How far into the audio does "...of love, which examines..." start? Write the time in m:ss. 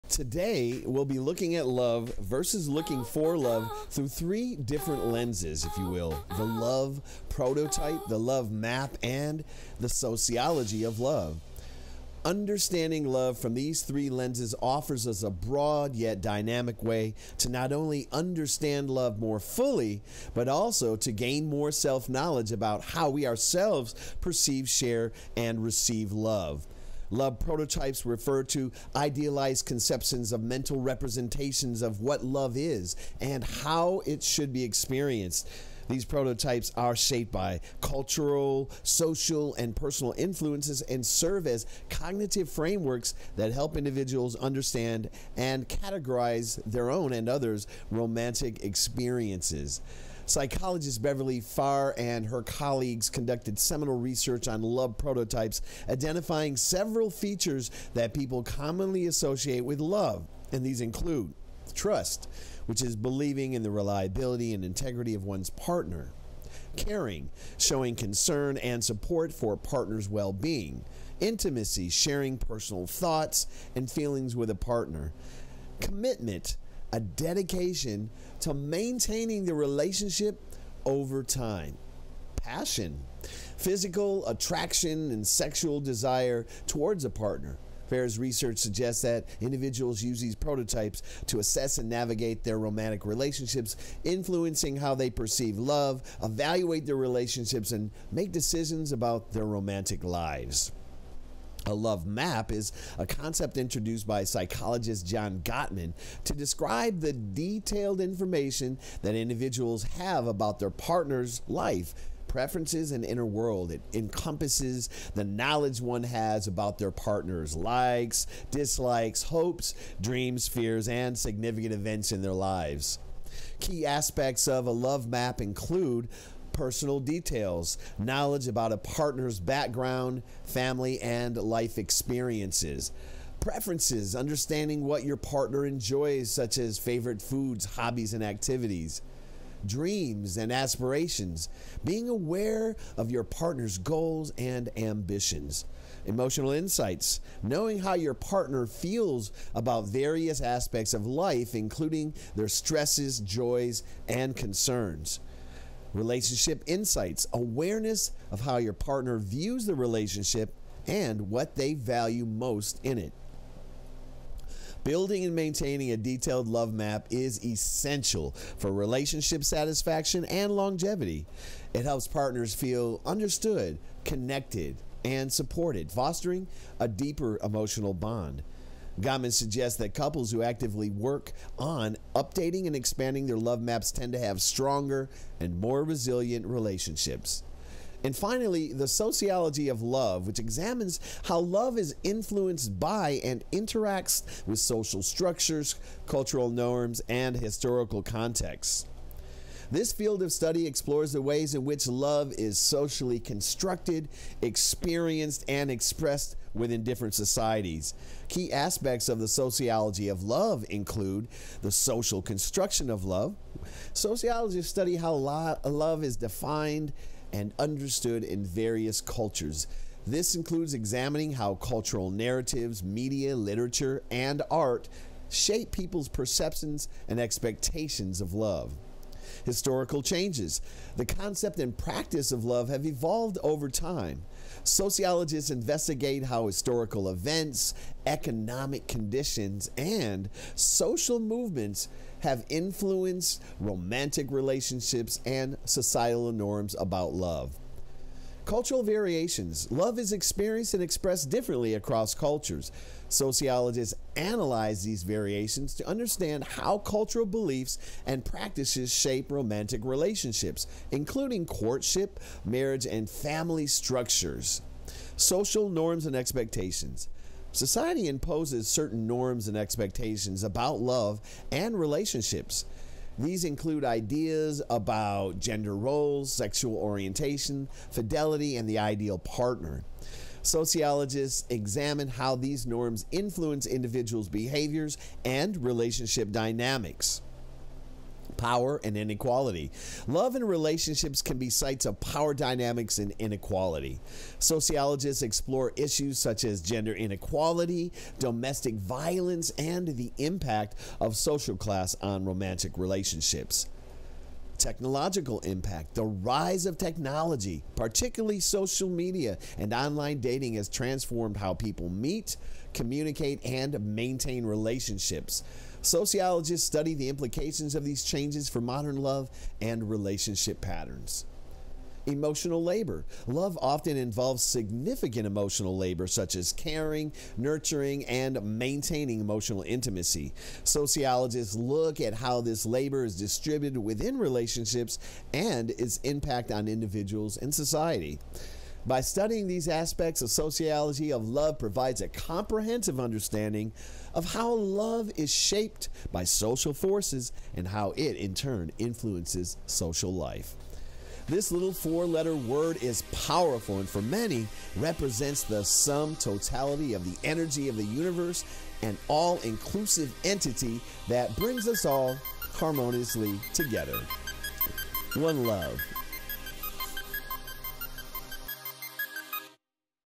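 3:09.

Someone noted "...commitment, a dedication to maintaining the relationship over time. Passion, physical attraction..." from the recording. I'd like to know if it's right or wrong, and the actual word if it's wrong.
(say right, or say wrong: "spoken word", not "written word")
right.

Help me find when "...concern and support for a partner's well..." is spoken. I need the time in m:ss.
1:07.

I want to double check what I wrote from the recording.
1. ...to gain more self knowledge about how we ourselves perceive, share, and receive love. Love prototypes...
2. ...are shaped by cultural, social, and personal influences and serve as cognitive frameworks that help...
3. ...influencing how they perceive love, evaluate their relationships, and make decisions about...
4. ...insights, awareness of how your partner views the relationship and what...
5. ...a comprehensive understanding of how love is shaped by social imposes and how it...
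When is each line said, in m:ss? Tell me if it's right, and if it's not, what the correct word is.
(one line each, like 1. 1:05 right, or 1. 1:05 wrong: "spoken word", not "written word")
1. 0:20 right
2. 0:36 right
3. 1:34 right
4. 2:36 right
5. 5:42 wrong: "forces", not "imposes".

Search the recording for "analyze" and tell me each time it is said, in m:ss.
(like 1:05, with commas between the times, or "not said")
4:14.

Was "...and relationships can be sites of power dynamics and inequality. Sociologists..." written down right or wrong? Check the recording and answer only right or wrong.
right.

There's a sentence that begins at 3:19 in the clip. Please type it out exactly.
This field of study explores the ways in which love is socially constructed, experienced, and expressed within different societies.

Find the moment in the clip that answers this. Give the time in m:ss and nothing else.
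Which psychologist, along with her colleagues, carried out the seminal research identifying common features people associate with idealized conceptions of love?
0:51.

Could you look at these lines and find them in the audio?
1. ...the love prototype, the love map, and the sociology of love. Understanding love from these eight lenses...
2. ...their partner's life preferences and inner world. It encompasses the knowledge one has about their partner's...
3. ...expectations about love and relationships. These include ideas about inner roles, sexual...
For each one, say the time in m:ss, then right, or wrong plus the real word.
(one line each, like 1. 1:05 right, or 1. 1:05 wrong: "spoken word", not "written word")
1. 0:06 wrong: "three", not "eight"
2. 1:50 right
3. 4:29 wrong: "gender", not "inner".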